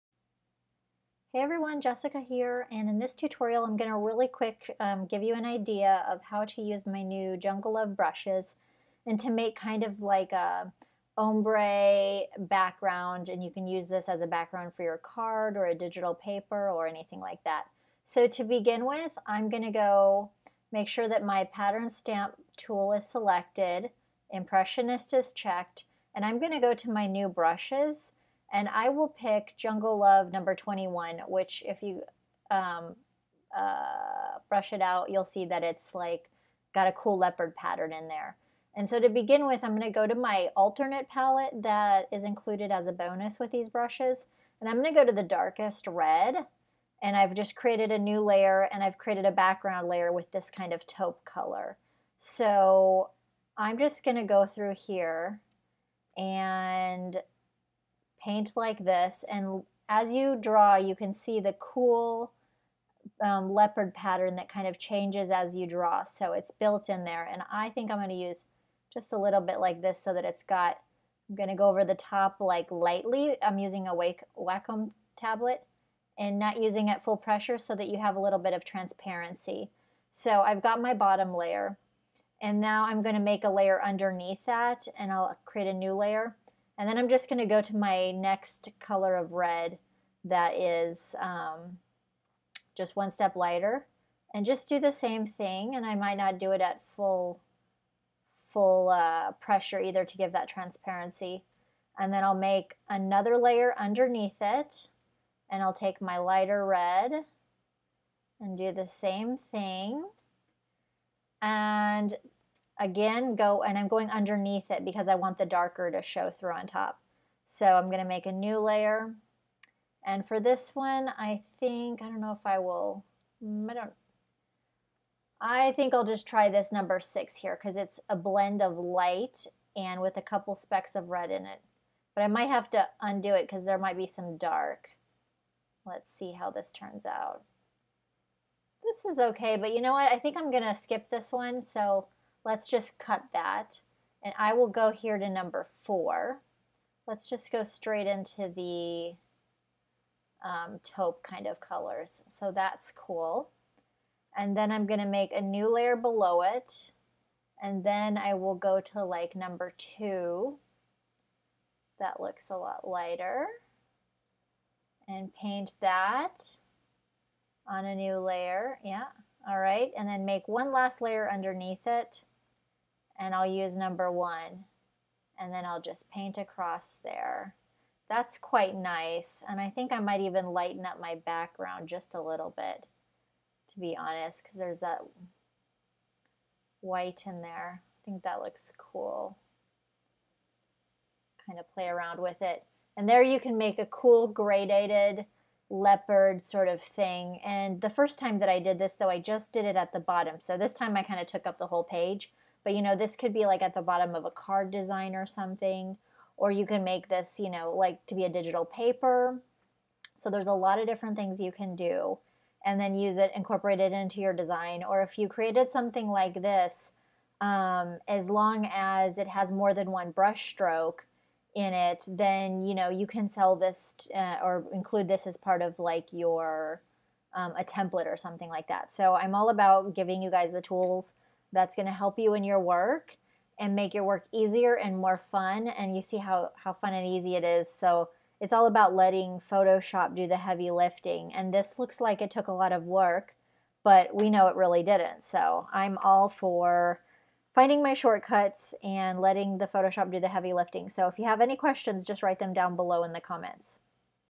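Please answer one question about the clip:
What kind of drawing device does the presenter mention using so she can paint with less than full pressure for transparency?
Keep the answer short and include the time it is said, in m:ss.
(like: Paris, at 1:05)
Wacom tablet, at 1:14.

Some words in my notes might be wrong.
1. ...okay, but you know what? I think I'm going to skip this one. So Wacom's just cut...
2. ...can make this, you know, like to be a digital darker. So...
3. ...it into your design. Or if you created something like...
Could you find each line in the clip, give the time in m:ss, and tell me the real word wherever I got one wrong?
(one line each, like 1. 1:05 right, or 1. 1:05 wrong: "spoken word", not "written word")
1. 2:19 wrong: "Let", not "Wacom"
2. 3:26 wrong: "paper", not "darker"
3. 3:33 right.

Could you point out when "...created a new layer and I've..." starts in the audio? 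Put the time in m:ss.
0:47.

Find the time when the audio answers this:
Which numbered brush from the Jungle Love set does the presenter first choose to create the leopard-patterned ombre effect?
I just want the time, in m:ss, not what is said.
0:29.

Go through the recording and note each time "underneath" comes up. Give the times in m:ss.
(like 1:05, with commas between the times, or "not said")
1:23, 1:43, 1:54, 2:51.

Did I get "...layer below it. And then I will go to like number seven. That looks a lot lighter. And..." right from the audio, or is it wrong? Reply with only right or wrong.
wrong.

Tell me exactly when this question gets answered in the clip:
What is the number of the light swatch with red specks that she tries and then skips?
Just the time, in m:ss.
2:06.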